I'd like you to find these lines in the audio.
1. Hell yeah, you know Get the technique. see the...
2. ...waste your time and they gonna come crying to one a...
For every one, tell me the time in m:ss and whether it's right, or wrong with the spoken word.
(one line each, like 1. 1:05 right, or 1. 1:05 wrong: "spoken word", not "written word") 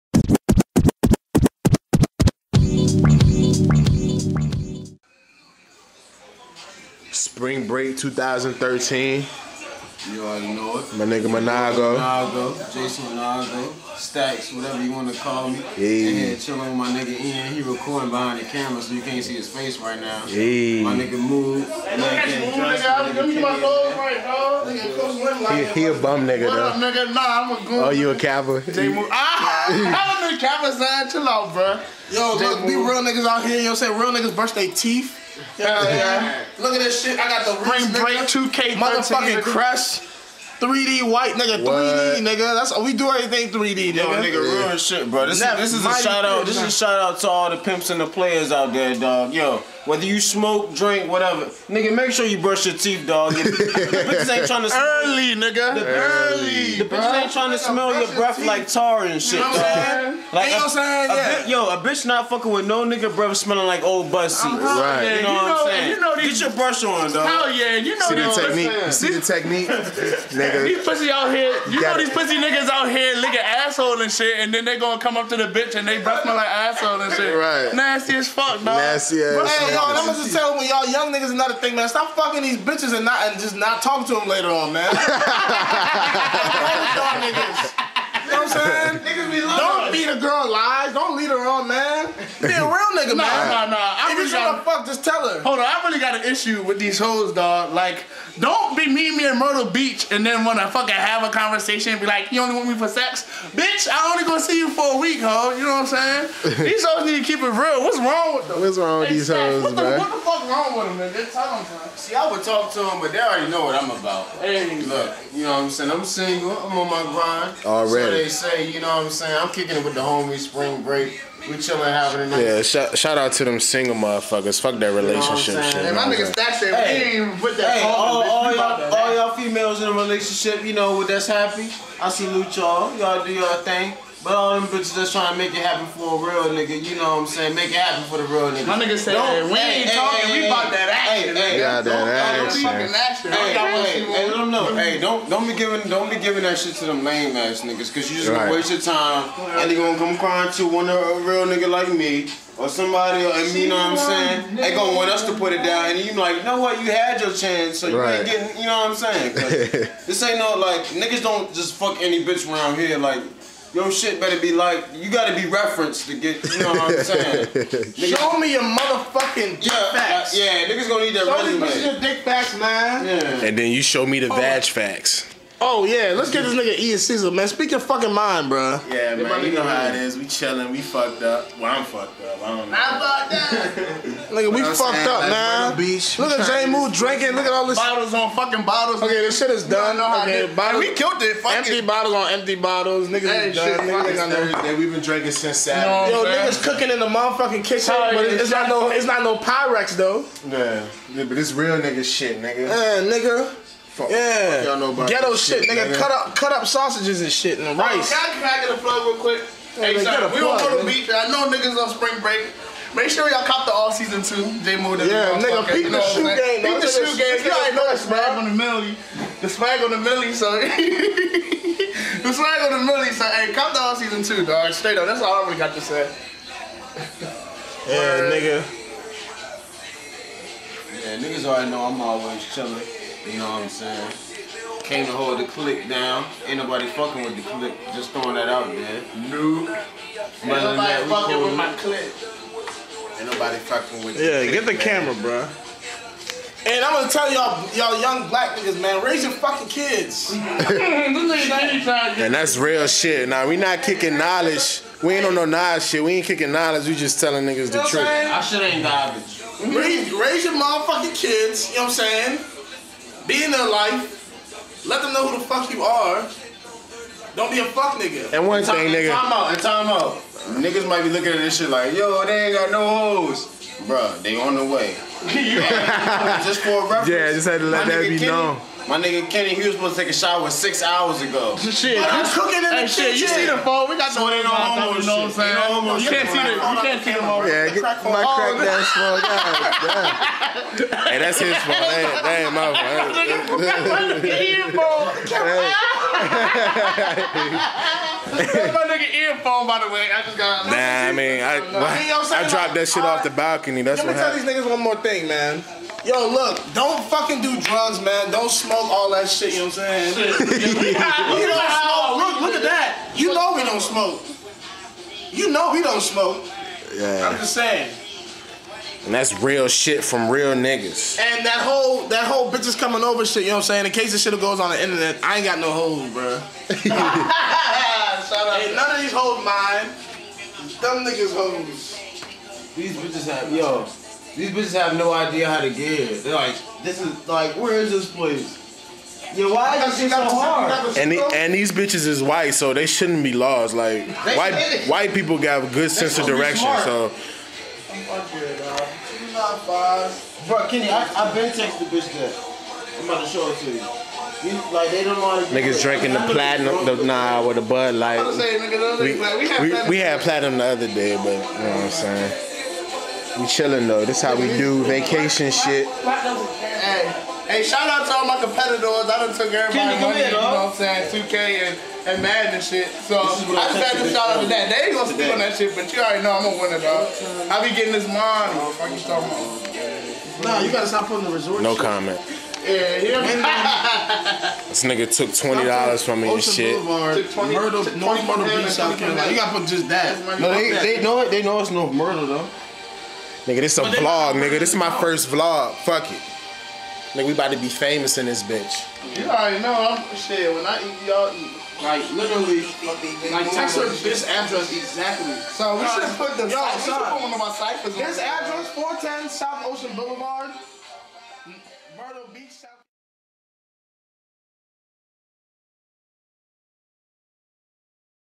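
1. 1:07 wrong: "See", not "Get"
2. 2:28 right.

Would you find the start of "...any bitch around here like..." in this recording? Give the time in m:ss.
2:42.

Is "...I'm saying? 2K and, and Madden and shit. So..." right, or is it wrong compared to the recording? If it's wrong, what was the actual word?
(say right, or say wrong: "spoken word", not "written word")
right.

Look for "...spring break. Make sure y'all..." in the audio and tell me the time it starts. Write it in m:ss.
3:31.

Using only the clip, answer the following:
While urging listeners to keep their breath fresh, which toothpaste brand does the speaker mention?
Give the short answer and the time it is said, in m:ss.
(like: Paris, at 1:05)
Crest, at 0:39.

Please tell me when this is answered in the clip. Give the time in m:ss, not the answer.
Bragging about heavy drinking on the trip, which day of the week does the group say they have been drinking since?
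3:15.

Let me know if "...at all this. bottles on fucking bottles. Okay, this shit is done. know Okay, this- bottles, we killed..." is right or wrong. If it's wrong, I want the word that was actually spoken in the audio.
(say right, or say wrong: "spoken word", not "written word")
right.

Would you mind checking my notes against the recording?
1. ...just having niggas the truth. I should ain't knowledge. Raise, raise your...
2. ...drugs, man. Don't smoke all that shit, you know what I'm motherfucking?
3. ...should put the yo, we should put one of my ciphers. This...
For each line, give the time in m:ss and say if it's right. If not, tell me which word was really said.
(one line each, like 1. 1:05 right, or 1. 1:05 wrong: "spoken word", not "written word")
1. 4:16 wrong: "telling", not "having"
2. 5:07 wrong: "saying", not "motherfucking"
3. 6:45 right.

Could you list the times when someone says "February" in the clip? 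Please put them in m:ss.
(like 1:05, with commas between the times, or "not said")
not said.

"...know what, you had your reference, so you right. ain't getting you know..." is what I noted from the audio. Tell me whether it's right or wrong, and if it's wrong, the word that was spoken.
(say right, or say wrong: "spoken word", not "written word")
wrong: "chance", not "reference".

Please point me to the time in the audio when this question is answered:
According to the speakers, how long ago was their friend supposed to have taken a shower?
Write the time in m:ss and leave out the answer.
4:40.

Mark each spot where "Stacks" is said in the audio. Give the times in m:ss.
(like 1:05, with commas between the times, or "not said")
0:13, 2:06.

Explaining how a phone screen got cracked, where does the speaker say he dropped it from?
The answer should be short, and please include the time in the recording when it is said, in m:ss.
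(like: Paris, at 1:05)
The balcony, at 5:03.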